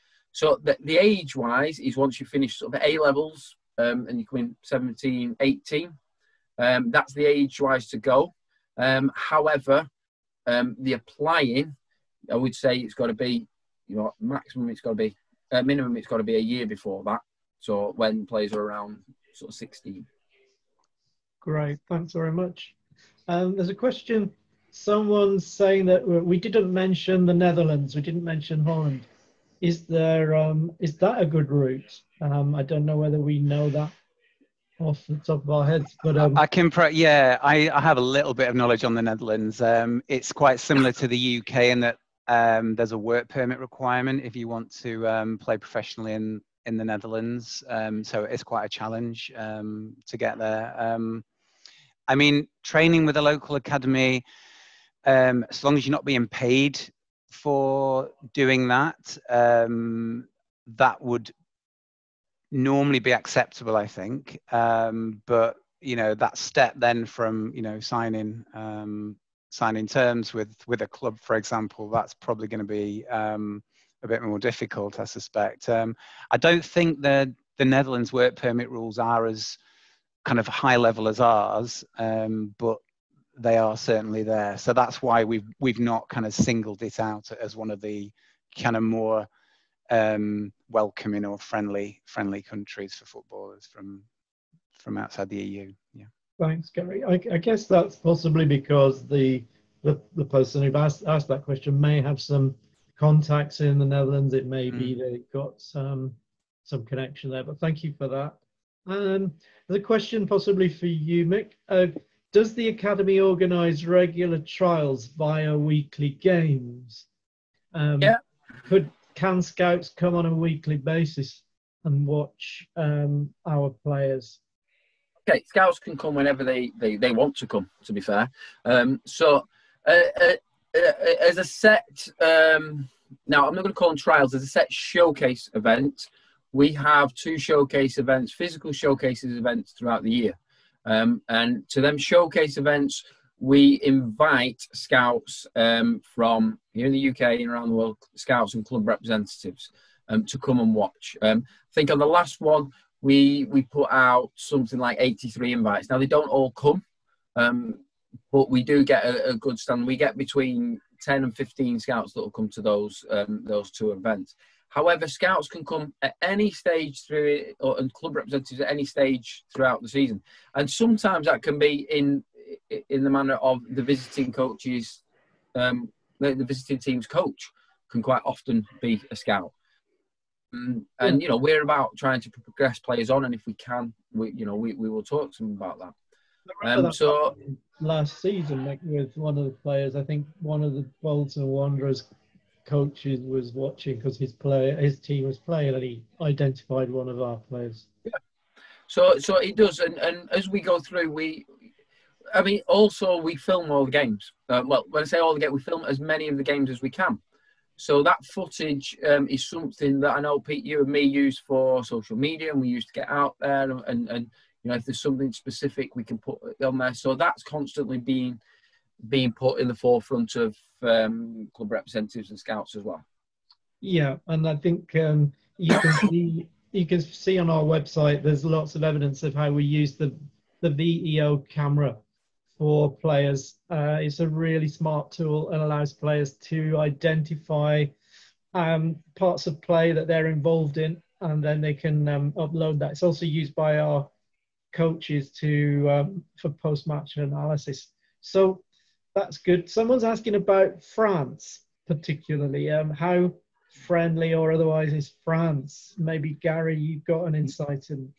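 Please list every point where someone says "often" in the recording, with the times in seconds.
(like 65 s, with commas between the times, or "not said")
178 s.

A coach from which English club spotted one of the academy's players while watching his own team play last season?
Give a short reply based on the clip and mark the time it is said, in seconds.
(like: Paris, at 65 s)
Bolton Wanderers, at 191 s.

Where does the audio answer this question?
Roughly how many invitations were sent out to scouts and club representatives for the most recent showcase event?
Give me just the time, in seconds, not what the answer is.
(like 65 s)
154 s.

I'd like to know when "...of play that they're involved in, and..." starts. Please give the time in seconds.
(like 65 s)
239 s.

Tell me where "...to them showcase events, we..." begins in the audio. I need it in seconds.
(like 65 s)
141 s.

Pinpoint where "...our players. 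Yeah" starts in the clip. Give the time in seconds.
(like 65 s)
197 s.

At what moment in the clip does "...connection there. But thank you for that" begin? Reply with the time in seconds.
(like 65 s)
106 s.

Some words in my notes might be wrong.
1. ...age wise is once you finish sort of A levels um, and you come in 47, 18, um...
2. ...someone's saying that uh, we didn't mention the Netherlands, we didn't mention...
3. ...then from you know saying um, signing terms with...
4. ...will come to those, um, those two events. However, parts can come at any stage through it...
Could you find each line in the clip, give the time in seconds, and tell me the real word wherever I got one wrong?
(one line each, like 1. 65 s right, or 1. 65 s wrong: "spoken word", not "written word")
1. 0 s wrong: "17", not "47"
2. 24 s right
3. 66 s wrong: "signing", not "saying"
4. 162 s wrong: "scouts", not "parts".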